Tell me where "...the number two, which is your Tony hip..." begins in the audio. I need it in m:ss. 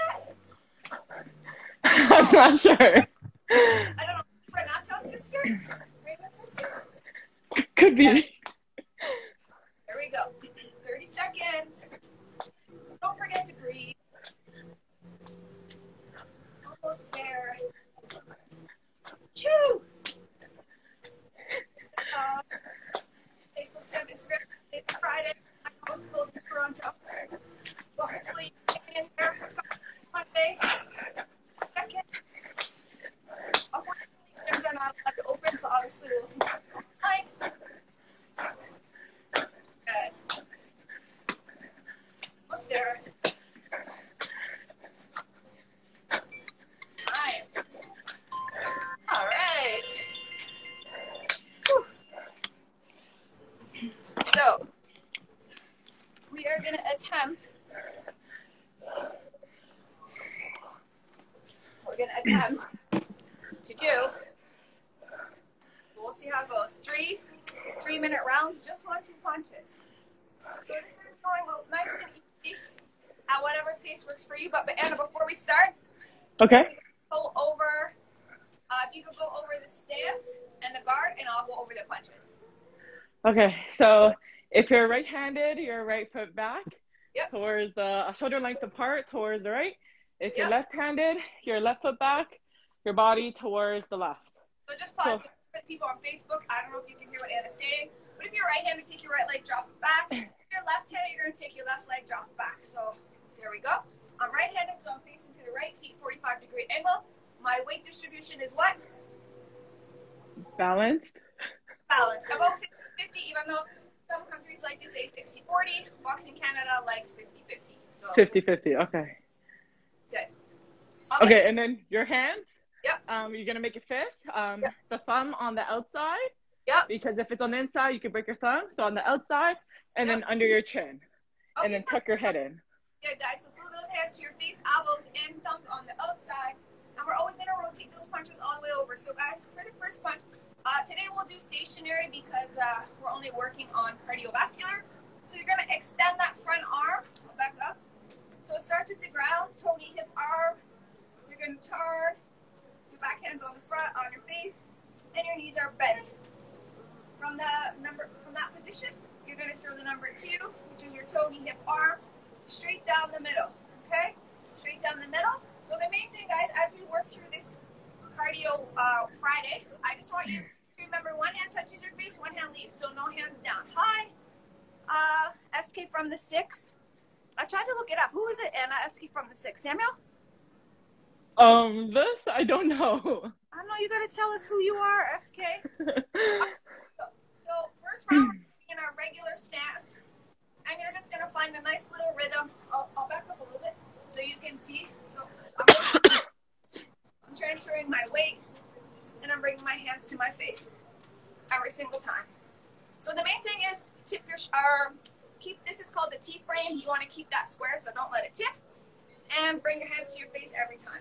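2:39.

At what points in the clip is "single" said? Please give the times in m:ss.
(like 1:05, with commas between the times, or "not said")
3:21.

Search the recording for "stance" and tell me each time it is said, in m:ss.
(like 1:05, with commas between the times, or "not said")
1:19, 3:09.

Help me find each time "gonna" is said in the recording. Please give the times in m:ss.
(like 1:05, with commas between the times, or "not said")
1:41, 2:25, 2:31, 2:39, 3:11.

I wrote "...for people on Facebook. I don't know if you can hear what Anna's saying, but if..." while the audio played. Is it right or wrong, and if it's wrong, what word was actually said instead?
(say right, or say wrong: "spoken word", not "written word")
right.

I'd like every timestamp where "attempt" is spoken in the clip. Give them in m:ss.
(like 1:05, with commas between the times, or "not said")
0:57, 1:02.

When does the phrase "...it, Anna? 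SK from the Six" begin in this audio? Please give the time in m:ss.
2:58.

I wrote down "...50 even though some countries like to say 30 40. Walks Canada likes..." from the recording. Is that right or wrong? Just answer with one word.
wrong.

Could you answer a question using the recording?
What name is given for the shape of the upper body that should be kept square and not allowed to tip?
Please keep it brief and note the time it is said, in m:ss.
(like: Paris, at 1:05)
T-frame, at 3:26.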